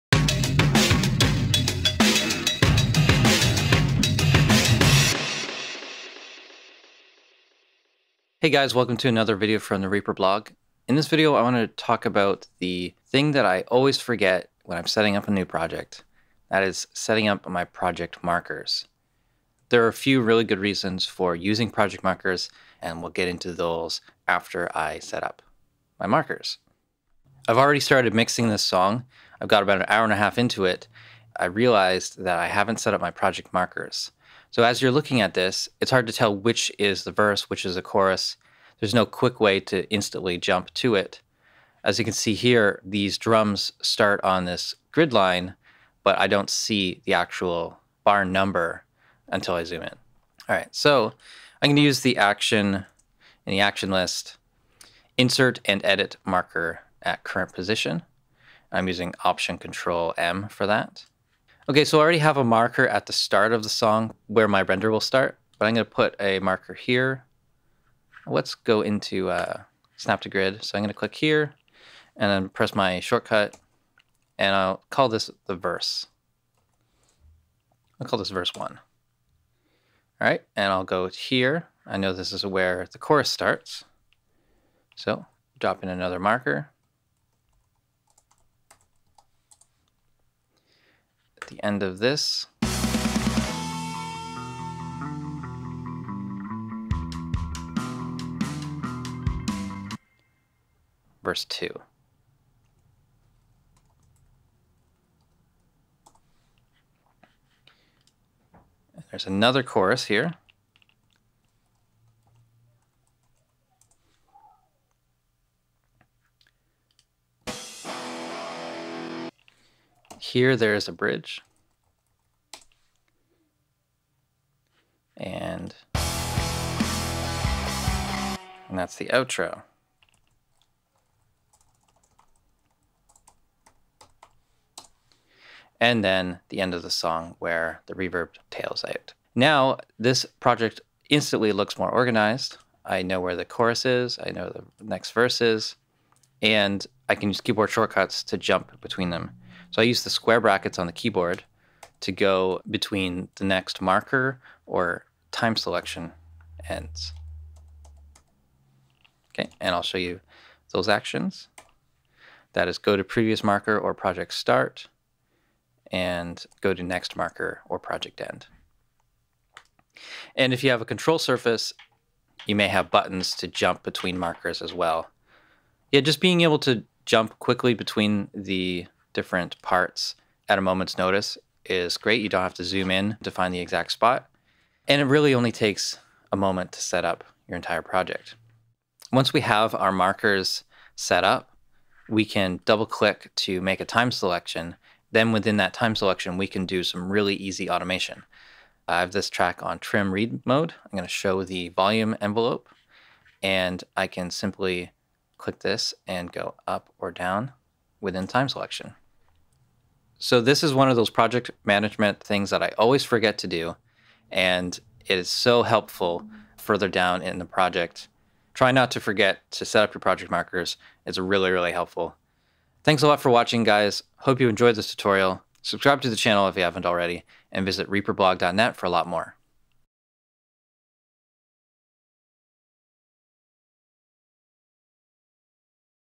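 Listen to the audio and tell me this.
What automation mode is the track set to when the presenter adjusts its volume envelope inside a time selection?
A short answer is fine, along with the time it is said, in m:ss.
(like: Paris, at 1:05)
trim read, at 3:19.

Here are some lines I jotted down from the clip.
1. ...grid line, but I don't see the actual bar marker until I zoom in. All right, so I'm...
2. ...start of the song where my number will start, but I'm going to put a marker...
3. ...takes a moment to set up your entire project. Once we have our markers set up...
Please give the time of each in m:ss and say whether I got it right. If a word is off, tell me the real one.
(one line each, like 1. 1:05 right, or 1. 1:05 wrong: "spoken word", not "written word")
1. 0:44 wrong: "number", not "marker"
2. 1:03 wrong: "render", not "number"
3. 3:05 right.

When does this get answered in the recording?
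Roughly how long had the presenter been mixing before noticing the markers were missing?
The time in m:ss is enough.
0:29.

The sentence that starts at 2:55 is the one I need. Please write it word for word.
Yeah, just being able to jump quickly between the different parts at a moment's notice is great.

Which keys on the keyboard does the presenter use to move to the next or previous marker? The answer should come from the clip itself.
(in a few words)
square brackets.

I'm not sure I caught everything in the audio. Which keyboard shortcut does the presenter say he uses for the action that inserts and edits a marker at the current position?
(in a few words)
Option Control M.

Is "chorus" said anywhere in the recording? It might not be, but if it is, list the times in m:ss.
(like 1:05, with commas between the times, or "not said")
0:37, 1:22, 1:49, 2:23.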